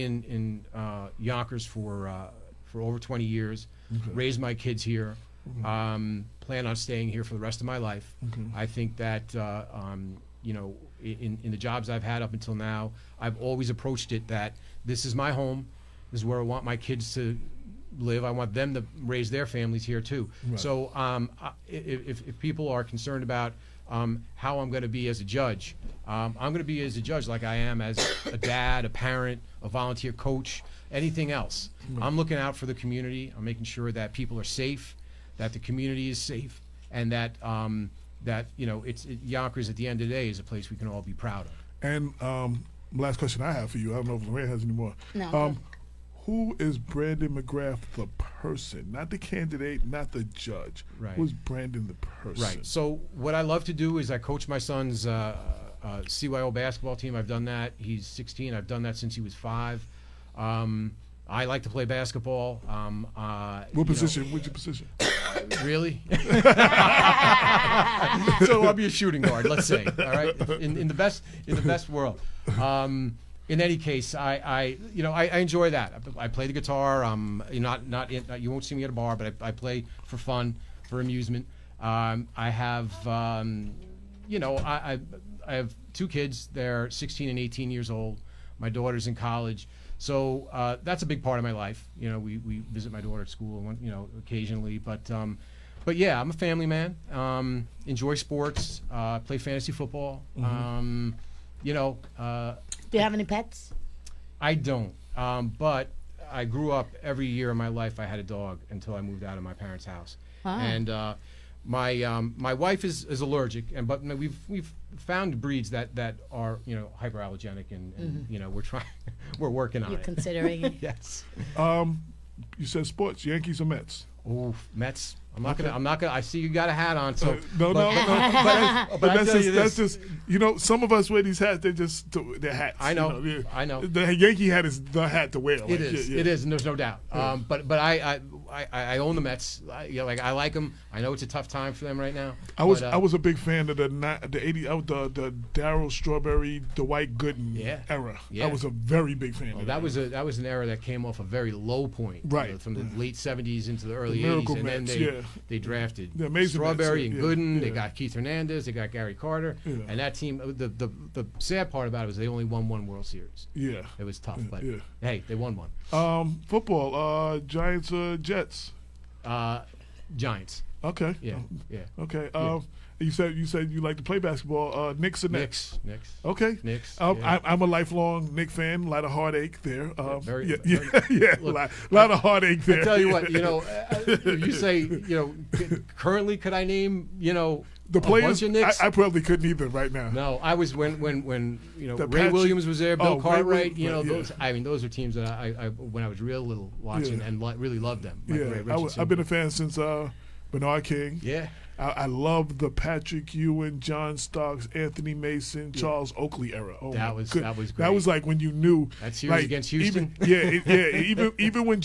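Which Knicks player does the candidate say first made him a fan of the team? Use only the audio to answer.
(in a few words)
Bernard King.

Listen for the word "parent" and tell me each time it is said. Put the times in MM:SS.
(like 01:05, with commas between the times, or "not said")
00:28, 01:49.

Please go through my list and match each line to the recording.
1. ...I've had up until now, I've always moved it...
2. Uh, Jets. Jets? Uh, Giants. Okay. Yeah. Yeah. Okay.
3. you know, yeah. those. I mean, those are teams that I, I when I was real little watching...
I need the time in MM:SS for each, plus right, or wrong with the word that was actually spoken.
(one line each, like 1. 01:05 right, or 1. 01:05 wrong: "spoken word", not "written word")
1. 00:11 wrong: "approached", not "moved"
2. 02:47 right
3. 03:13 right.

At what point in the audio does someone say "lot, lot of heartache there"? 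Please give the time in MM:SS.
03:01.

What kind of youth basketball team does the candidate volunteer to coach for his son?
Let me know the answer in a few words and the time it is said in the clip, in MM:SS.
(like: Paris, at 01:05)
CYO, at 00:56.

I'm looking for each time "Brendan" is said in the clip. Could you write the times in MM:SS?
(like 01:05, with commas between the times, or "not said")
00:46, 00:51.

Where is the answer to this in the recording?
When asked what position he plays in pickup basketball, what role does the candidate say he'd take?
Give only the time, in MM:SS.
01:08.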